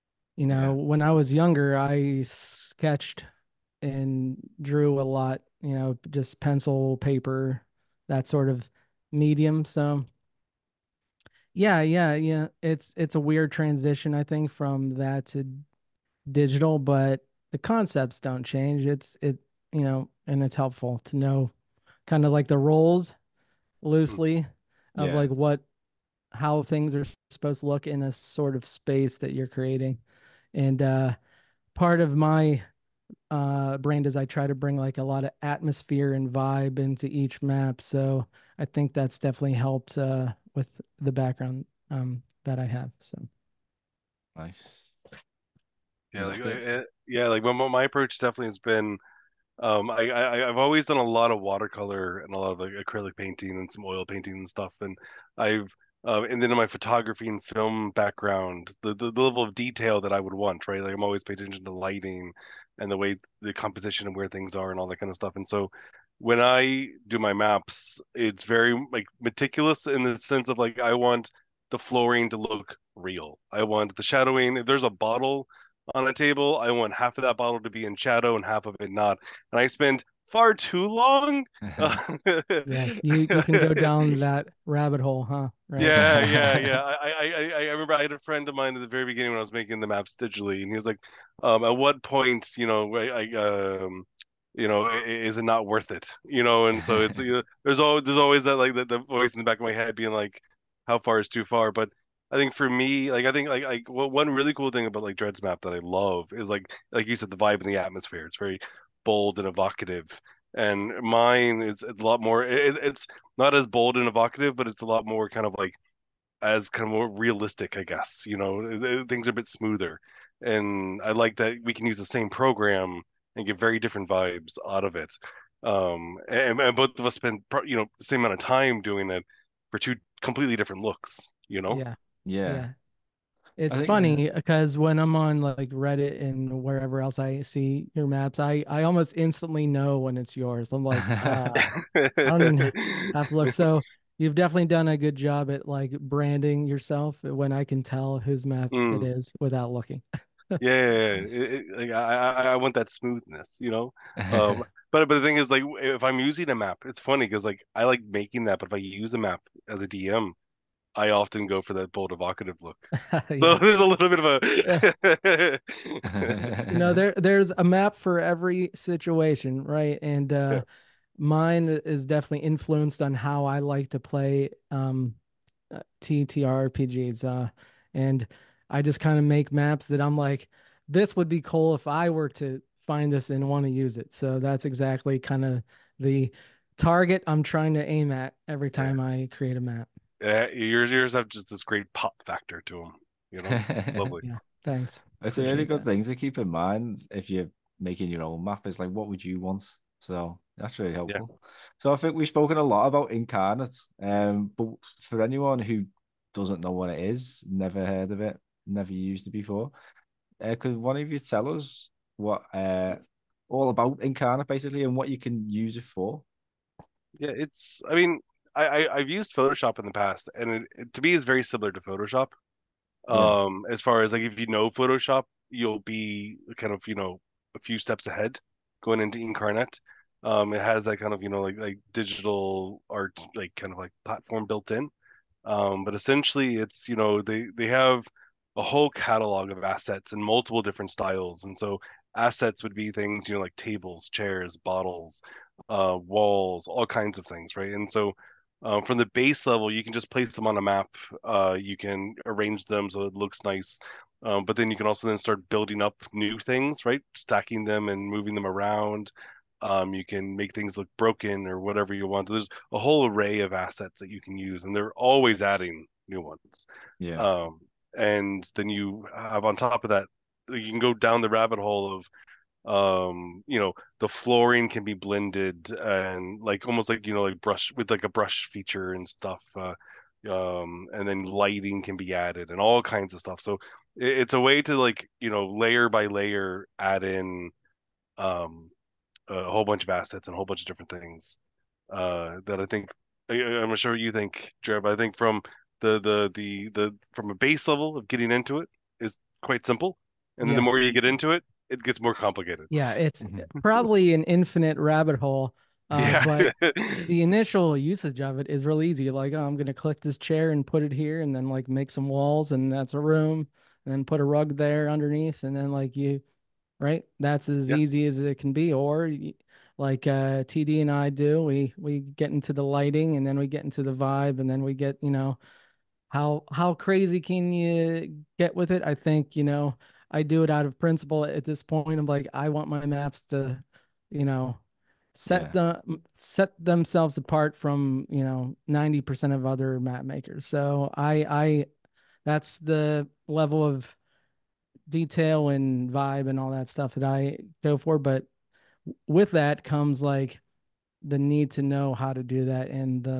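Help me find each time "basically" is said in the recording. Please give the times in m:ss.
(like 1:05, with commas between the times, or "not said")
3:34.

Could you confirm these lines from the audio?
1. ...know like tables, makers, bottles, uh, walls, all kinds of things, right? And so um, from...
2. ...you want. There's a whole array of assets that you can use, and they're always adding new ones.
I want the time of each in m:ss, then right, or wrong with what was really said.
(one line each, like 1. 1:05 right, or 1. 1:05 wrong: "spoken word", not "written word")
1. 4:03 wrong: "chairs", not "makers"
2. 4:21 right.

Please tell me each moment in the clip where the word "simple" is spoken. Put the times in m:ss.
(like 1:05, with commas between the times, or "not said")
4:59.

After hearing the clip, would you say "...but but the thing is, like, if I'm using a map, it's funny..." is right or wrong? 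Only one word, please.
right.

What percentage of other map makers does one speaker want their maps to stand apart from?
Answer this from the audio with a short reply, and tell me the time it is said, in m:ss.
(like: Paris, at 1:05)
90%, at 5:38.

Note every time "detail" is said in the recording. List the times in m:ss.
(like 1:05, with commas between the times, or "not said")
0:59, 5:44.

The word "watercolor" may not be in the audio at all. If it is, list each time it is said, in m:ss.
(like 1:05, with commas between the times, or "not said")
0:51.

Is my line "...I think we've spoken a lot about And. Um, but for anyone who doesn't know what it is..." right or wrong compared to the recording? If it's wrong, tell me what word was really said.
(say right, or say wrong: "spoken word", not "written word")
wrong: "Inkarnate", not "And".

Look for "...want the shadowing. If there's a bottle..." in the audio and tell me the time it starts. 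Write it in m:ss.
1:13.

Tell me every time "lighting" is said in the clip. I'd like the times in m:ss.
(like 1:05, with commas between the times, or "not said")
1:01, 4:41, 5:22.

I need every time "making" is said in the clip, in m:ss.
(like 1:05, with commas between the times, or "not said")
1:29, 2:38, 3:17.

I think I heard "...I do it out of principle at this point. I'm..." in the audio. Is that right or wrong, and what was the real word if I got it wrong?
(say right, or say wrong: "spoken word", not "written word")
right.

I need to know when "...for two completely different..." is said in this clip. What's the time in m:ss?
2:09.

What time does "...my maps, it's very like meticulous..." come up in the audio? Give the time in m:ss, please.
1:07.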